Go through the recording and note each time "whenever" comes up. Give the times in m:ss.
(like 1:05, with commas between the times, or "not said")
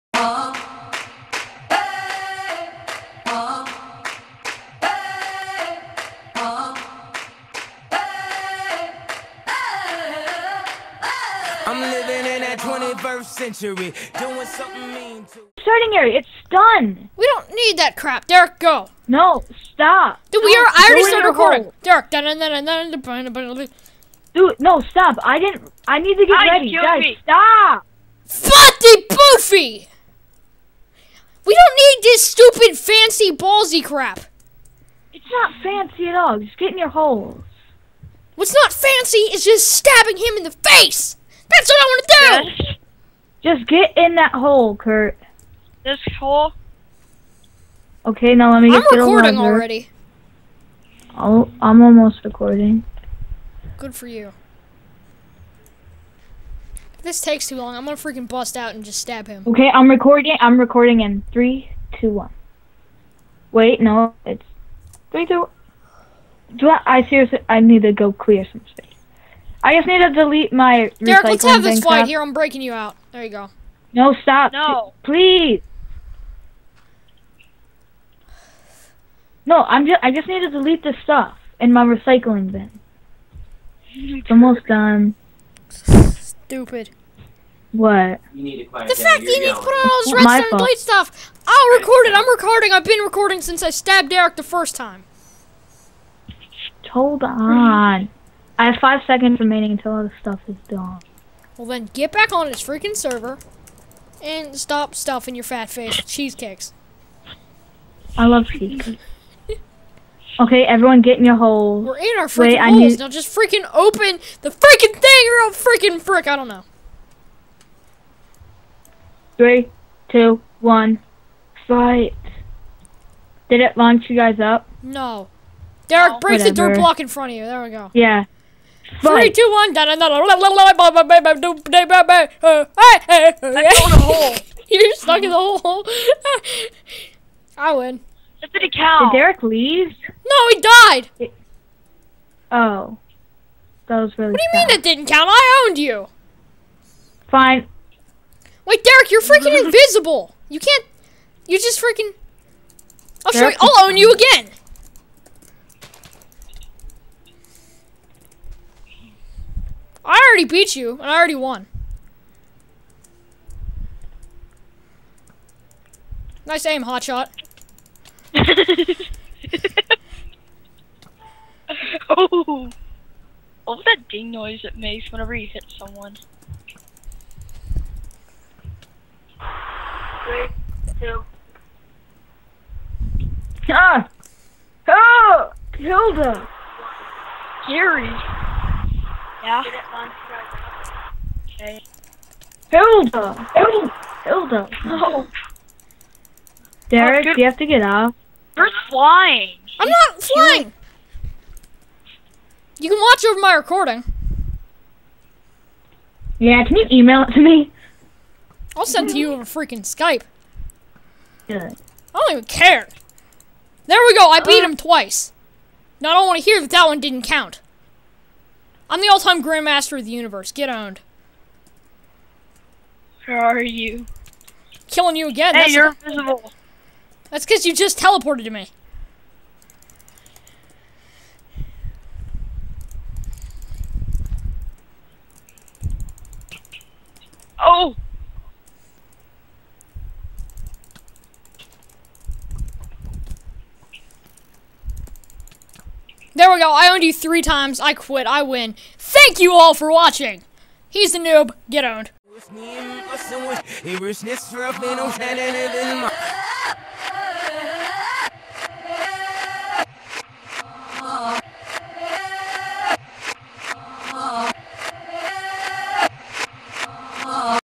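2:55.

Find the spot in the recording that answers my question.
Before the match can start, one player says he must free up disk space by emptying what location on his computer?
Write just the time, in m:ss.
1:21.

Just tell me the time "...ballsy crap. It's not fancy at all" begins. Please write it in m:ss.
0:33.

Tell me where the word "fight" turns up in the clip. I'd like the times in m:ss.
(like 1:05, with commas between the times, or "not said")
1:11, 2:01.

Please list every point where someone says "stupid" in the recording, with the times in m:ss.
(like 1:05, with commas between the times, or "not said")
0:32, 1:25.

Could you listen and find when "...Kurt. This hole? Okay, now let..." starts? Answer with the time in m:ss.
0:44.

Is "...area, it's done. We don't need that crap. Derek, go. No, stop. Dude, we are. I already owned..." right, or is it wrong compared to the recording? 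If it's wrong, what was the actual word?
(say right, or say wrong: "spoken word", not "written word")
wrong: "started", not "owned".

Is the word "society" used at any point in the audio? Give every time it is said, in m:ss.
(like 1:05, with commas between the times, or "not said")
not said.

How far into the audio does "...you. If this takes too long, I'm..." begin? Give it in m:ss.
0:54.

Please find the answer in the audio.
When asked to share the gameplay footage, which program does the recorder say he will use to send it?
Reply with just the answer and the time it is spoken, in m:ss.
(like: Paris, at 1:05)
Skype, at 3:29.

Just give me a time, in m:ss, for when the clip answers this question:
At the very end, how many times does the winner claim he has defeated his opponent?
4:07.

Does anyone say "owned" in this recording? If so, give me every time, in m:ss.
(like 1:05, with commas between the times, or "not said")
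2:25, 3:40, 4:06, 4:11.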